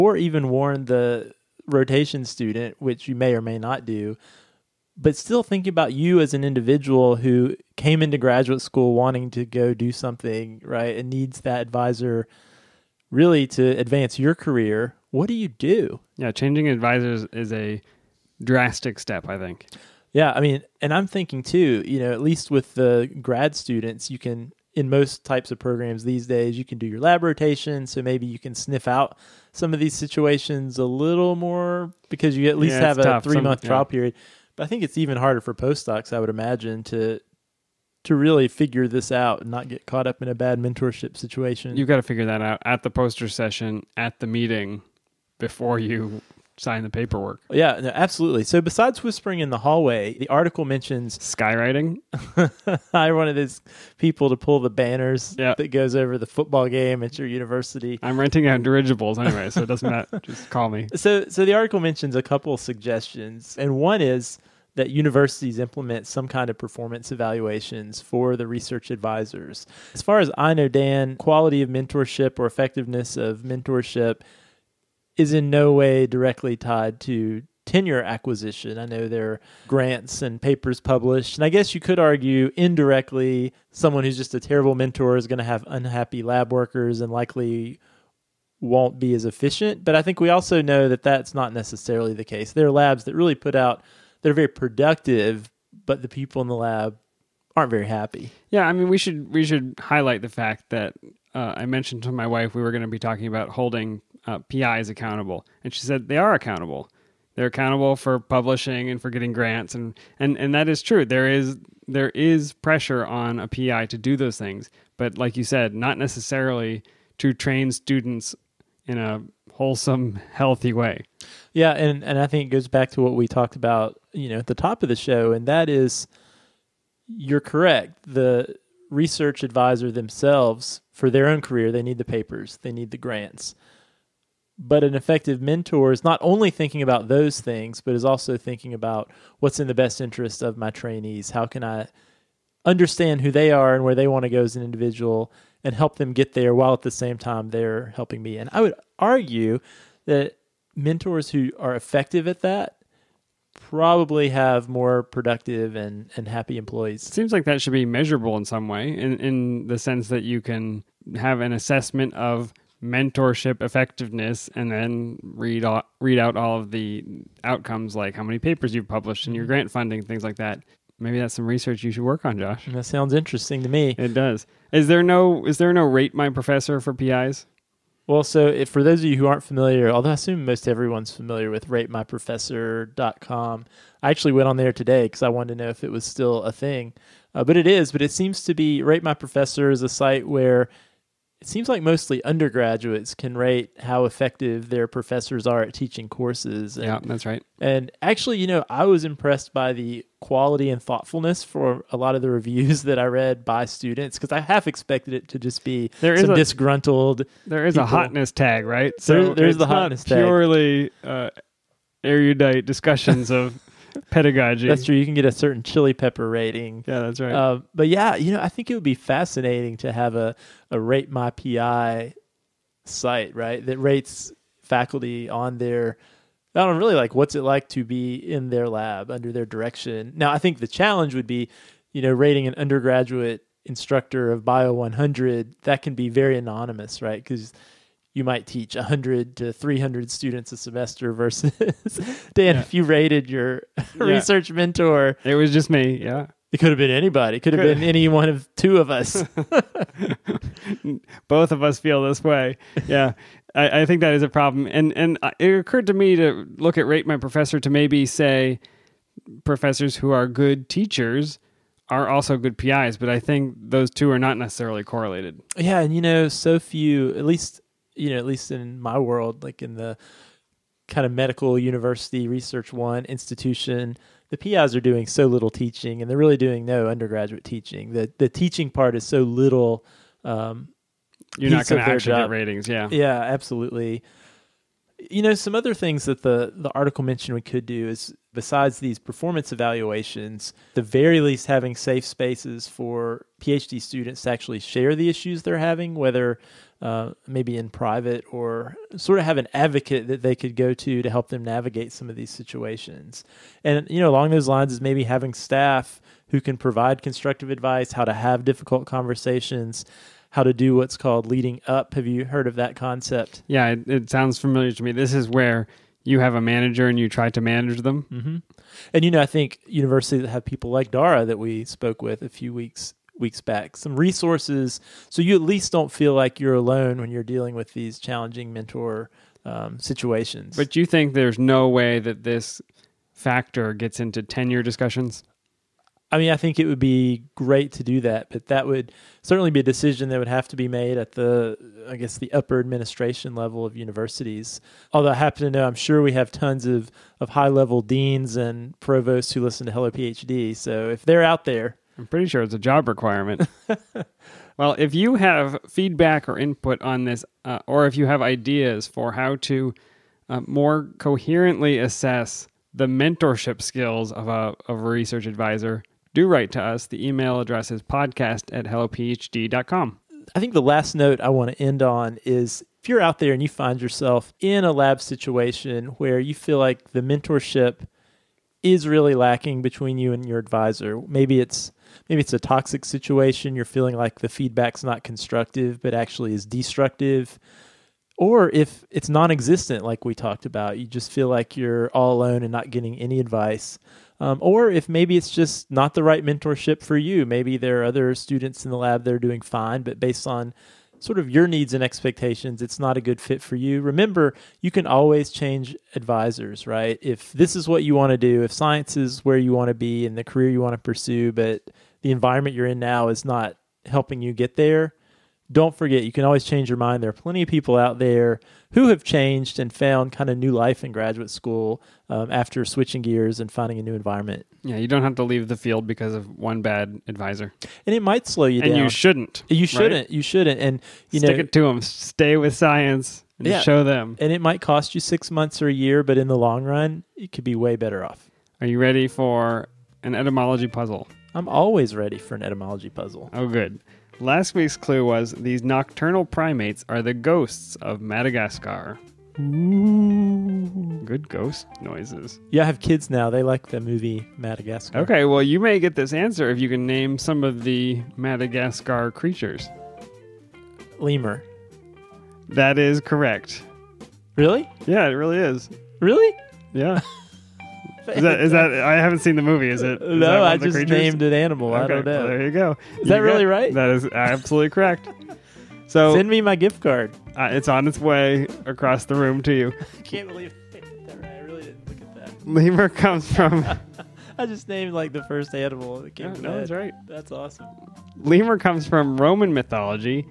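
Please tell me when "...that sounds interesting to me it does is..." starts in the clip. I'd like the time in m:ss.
2:52.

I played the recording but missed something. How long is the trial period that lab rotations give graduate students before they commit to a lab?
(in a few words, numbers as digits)
3 months.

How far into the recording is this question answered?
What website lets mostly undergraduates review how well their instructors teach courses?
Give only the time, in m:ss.
3:01.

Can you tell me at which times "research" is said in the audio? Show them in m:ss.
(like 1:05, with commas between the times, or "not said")
1:08, 2:08, 2:51, 4:04, 4:32, 6:04.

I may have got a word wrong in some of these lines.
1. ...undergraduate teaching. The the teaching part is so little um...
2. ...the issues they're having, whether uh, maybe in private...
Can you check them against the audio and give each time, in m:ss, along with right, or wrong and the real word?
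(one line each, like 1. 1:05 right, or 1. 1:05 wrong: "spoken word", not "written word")
1. 4:36 right
2. 4:54 right.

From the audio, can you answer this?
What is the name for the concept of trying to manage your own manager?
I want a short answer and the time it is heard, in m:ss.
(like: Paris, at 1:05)
Leading up, at 5:11.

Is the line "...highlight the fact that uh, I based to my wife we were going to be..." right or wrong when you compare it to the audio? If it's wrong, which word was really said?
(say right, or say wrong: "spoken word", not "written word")
wrong: "mentioned", not "based".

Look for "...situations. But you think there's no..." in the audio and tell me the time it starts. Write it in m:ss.
5:29.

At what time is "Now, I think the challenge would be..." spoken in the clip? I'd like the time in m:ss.
3:50.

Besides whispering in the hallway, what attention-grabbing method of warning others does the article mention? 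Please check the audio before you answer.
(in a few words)
Skywriting.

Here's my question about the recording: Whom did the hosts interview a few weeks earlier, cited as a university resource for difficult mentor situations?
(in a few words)
Dara.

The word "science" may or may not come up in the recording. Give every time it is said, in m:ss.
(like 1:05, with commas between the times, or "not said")
6:48, 7:12.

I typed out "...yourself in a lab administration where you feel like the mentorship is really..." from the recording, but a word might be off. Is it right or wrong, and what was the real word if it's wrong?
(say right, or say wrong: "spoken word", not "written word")
wrong: "situation", not "administration".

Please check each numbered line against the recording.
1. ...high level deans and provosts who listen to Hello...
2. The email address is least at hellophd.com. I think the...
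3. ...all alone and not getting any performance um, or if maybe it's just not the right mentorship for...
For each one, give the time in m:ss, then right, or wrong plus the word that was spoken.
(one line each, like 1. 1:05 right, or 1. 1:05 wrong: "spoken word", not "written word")
1. 5:47 right
2. 6:06 wrong: "podcast", not "least"
3. 6:31 wrong: "advice", not "performance".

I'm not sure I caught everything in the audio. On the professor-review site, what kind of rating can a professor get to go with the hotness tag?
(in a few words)
Chili pepper rating.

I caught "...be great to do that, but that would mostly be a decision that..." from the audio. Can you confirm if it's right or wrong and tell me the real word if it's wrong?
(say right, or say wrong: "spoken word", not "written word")
wrong: "certainly", not "mostly".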